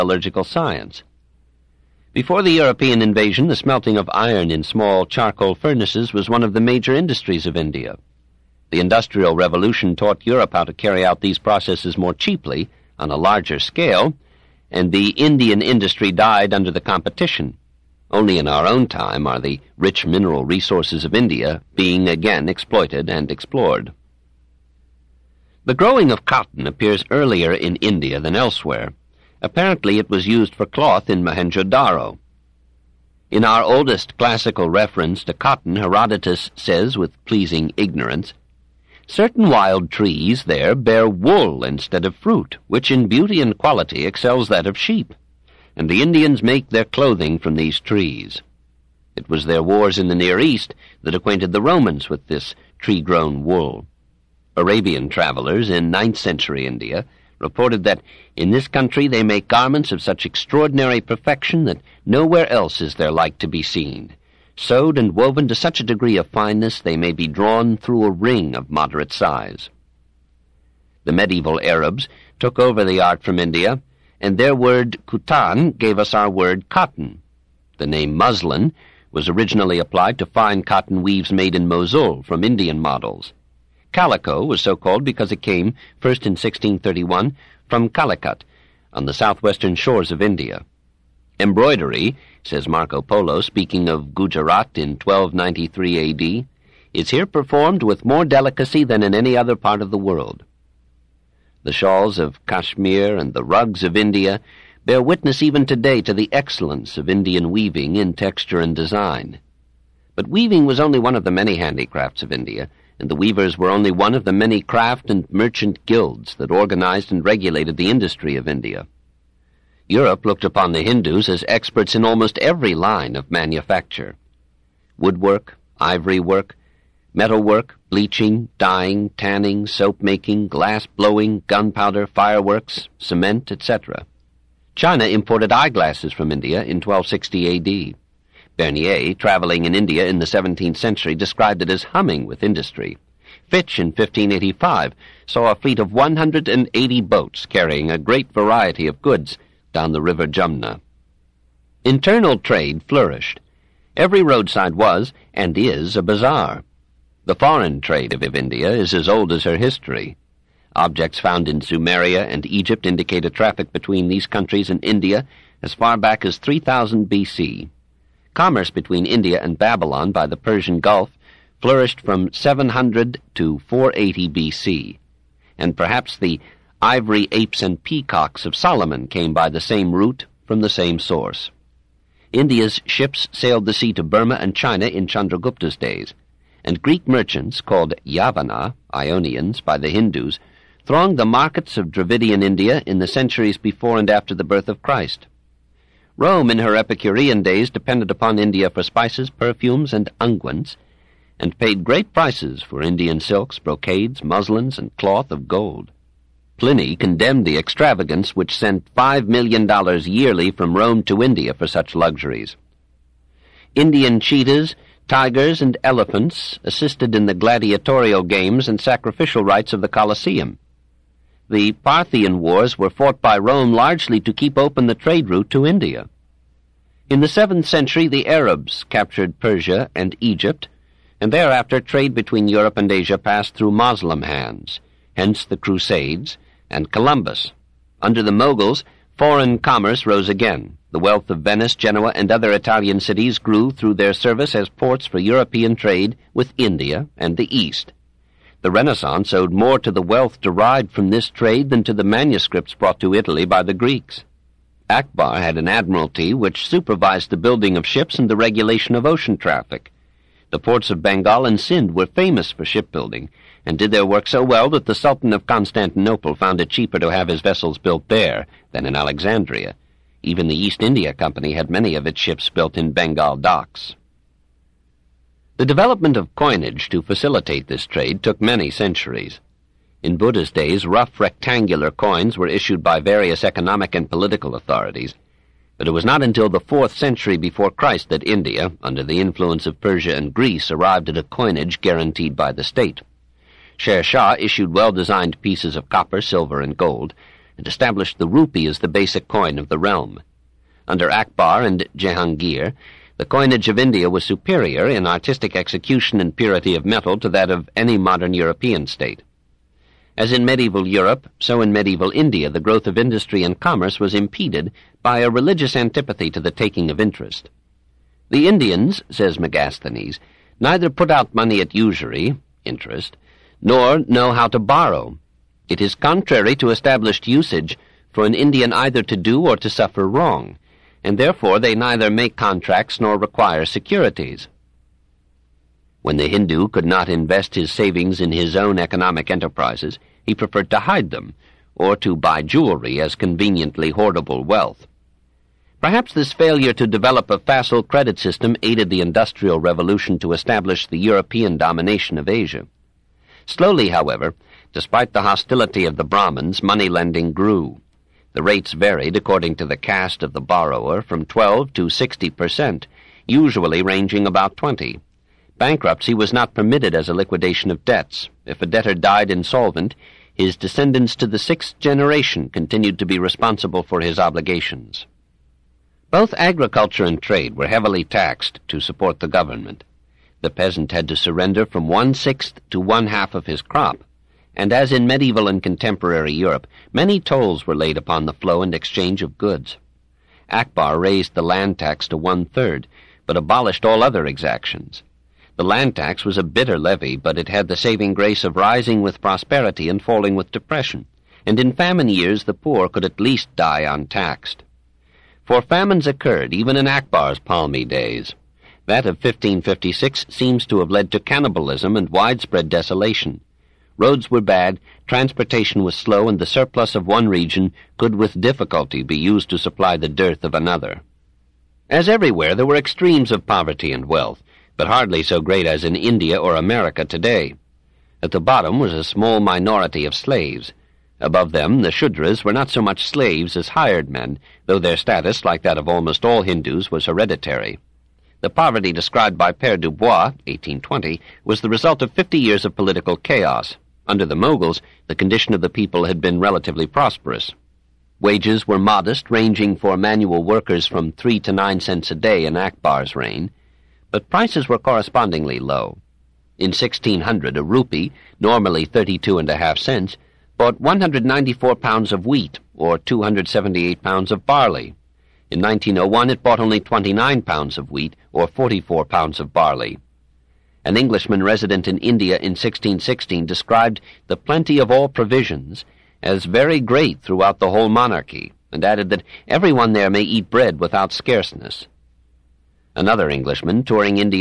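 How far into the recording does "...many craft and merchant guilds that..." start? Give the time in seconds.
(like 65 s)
114 s.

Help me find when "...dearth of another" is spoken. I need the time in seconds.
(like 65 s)
420 s.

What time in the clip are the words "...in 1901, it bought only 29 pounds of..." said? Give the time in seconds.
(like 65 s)
465 s.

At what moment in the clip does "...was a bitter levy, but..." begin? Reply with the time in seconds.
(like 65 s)
396 s.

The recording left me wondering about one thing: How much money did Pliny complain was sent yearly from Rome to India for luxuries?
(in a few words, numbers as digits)
$5 million.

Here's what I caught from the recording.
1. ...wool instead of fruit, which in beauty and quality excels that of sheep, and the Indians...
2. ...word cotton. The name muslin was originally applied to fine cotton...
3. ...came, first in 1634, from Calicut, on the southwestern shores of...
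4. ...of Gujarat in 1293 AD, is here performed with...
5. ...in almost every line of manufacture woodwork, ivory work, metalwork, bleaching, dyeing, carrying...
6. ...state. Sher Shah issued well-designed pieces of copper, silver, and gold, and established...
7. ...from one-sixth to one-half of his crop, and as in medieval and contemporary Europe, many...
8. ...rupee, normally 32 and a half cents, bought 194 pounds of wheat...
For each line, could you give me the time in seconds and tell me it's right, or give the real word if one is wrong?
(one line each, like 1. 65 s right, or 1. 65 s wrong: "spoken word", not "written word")
1. 41 s right
2. 76 s right
3. 85 s wrong: "1631", not "1634"
4. 93 s right
5. 121 s wrong: "tanning", not "carrying"
6. 292 s right
7. 381 s right
8. 457 s right.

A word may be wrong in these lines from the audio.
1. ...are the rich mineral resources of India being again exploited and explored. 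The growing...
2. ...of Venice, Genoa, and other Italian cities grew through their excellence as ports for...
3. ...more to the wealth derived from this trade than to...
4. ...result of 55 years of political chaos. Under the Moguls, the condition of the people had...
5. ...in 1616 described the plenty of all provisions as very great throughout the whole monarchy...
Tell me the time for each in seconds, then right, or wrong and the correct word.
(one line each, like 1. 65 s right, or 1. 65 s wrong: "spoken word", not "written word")
1. 19 s right
2. 241 s wrong: "service", not "excellence"
3. 249 s right
4. 441 s wrong: "50", not "55"
5. 472 s right.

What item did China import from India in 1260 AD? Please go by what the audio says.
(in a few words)
Eyeglasses.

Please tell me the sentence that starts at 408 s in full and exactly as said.
That of 1556 seems to have led to cannibalism and widespread desolation.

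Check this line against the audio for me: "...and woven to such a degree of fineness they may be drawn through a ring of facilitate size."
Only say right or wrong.
wrong.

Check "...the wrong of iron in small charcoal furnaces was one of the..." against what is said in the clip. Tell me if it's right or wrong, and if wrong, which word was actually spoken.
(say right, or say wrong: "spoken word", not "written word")
wrong: "smelting", not "wrong".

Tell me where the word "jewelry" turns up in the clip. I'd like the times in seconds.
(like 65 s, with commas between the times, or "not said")
342 s.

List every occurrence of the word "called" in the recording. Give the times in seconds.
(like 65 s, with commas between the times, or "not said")
84 s, 187 s.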